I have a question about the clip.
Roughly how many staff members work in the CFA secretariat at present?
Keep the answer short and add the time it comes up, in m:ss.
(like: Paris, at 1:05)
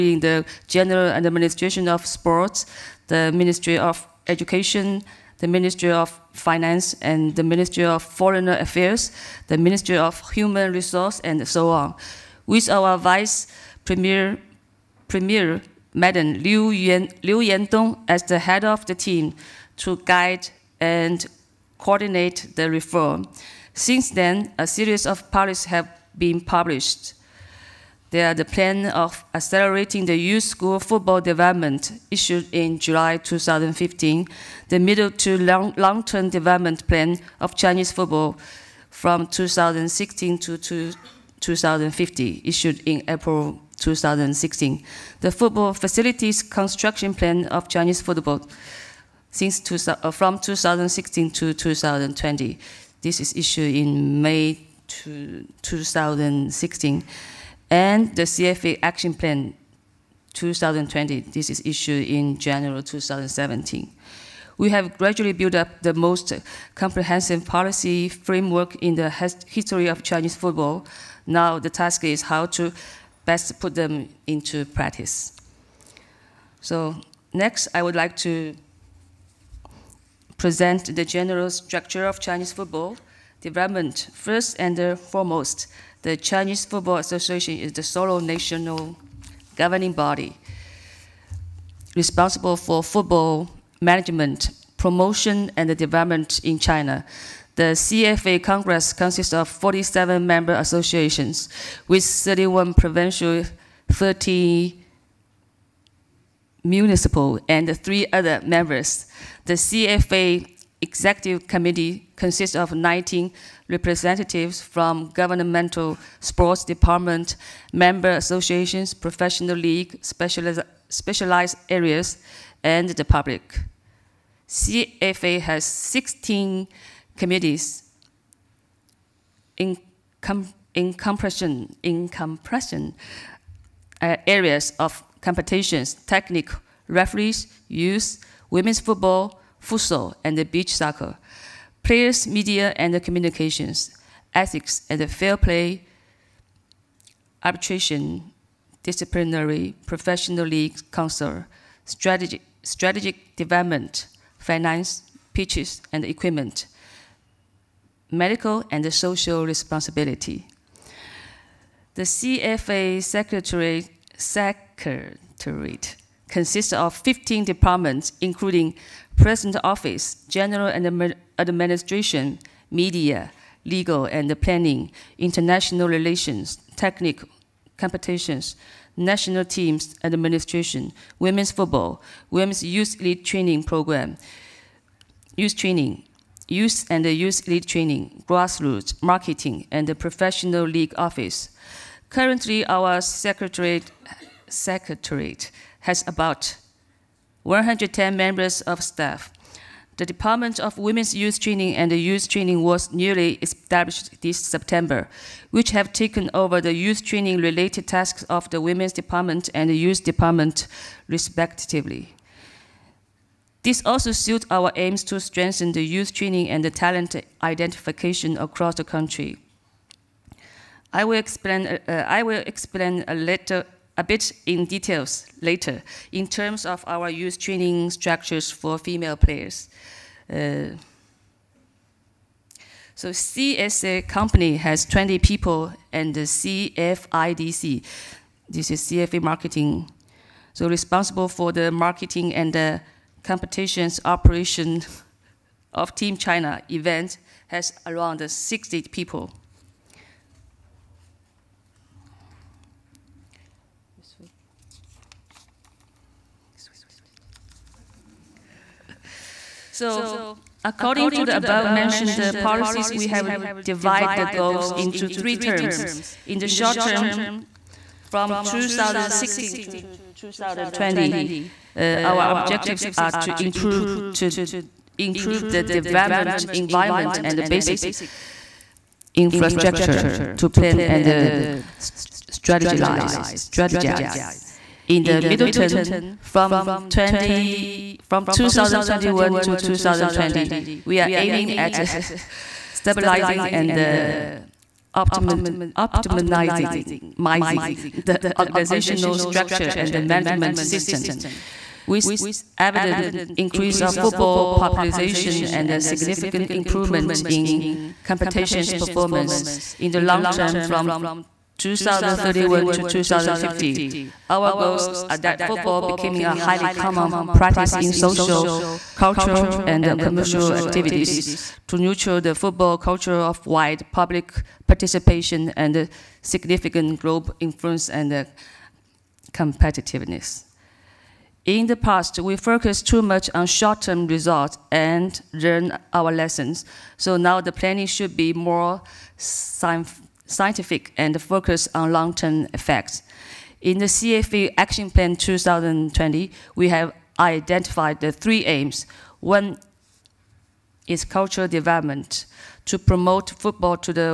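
110, at 3:17.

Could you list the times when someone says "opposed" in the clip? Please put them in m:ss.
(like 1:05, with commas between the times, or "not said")
not said.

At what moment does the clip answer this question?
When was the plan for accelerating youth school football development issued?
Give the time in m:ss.
0:32.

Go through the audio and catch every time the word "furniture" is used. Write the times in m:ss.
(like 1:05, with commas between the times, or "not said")
not said.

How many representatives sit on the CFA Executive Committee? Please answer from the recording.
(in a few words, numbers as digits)
19.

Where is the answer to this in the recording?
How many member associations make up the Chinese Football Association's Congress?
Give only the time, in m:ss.
1:39.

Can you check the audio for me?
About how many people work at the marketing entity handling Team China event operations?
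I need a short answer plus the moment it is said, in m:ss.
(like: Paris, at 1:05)
60, at 4:08.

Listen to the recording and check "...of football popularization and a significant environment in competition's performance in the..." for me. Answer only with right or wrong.
wrong.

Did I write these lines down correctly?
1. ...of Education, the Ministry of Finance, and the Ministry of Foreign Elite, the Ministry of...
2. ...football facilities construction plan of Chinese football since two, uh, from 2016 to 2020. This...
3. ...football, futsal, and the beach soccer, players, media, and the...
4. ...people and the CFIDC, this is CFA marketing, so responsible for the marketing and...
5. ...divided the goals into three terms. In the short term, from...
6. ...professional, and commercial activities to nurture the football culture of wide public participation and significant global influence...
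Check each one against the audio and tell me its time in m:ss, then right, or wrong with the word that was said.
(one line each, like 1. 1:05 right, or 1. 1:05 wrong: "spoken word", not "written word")
1. 0:03 wrong: "Affairs", not "Elite"
2. 0:45 right
3. 2:18 right
4. 3:55 right
5. 4:23 right
6. 5:18 wrong: "cultural", not "professional".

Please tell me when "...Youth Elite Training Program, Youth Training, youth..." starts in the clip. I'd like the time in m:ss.
3:02.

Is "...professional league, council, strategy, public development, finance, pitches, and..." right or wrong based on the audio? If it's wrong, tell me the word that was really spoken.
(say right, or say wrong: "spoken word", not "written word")
wrong: "strategic", not "public".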